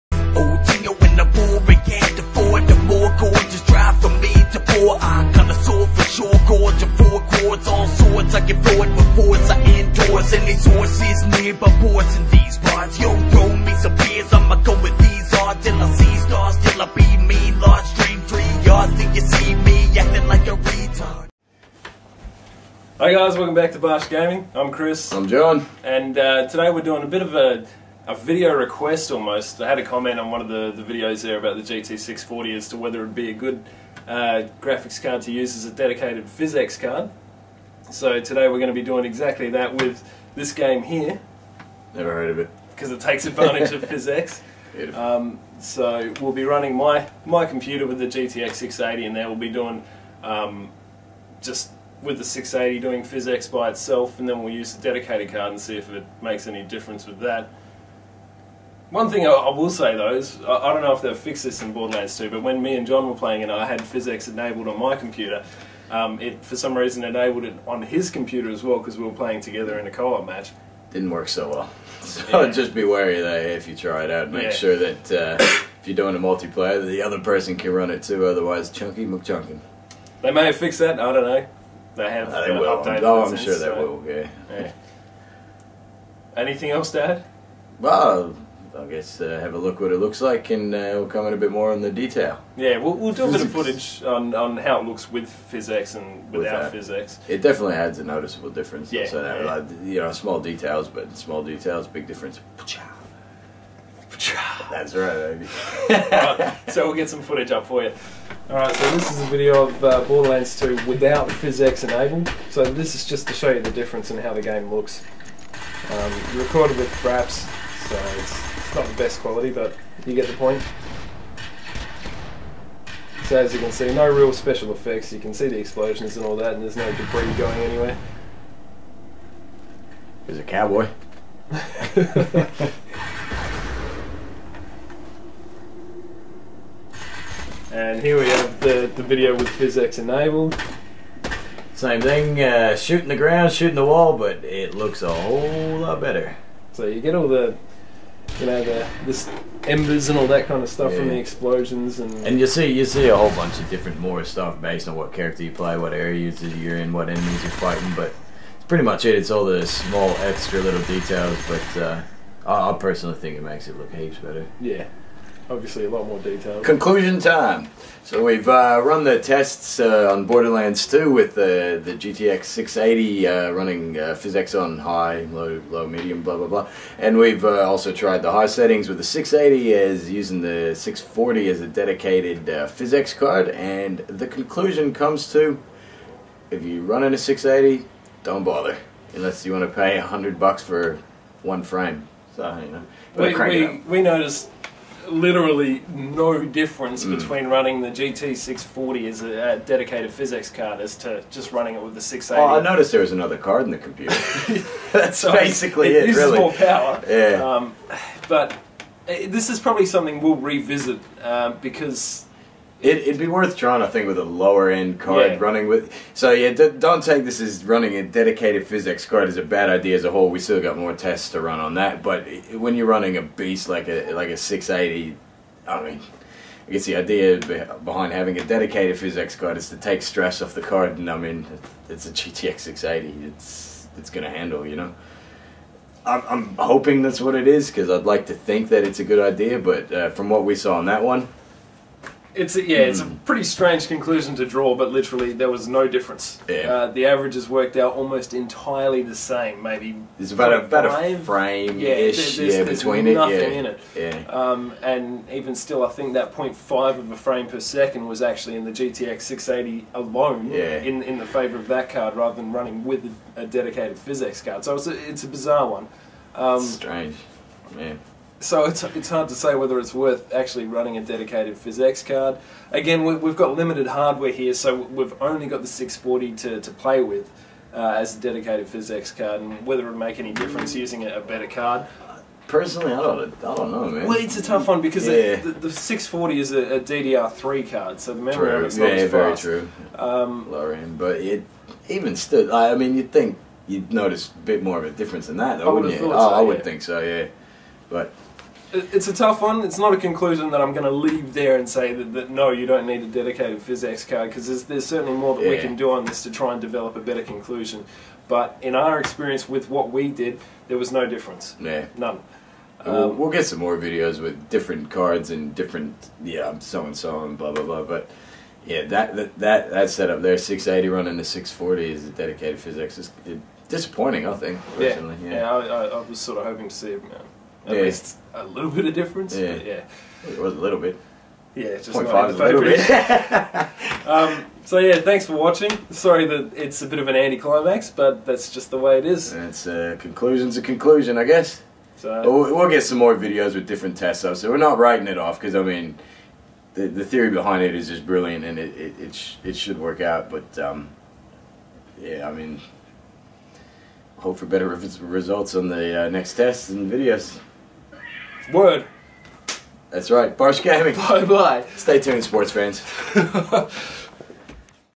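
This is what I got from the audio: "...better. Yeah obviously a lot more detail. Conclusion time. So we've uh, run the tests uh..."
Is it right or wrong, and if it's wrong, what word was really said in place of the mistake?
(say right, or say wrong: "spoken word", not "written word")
right.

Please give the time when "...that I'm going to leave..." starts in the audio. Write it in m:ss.
5:00.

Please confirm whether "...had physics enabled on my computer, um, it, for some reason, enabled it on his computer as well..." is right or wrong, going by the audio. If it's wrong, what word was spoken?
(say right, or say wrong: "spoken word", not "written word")
right.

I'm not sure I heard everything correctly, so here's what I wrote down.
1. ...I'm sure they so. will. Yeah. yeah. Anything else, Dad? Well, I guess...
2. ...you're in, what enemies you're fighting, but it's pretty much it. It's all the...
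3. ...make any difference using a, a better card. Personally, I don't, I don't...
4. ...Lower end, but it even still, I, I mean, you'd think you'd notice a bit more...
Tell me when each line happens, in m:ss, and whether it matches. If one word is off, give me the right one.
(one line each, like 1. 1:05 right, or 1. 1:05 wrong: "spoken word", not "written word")
1. 1:23 right
2. 2:36 right
3. 4:39 right
4. 4:50 right.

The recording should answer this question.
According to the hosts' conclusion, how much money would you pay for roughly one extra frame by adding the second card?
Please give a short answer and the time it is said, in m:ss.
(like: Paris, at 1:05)
100 bucks, at 3:09.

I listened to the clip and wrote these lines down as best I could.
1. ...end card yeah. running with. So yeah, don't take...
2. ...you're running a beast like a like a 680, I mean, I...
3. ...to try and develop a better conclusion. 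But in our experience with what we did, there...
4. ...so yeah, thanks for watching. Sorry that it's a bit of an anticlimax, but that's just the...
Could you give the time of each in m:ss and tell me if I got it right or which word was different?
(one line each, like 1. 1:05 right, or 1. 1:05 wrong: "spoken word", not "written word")
1. 3:34 right
2. 3:42 right
3. 5:06 right
4. 5:34 right.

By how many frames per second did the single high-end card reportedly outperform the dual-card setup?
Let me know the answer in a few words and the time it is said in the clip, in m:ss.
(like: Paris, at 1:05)
0.5, at 4:16.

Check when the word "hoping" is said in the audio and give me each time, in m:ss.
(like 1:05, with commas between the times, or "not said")
3:56, 5:26.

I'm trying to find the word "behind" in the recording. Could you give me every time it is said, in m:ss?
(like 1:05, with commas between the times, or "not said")
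3:47, 5:47.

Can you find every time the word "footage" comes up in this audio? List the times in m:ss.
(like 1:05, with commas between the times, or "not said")
1:33, 1:47.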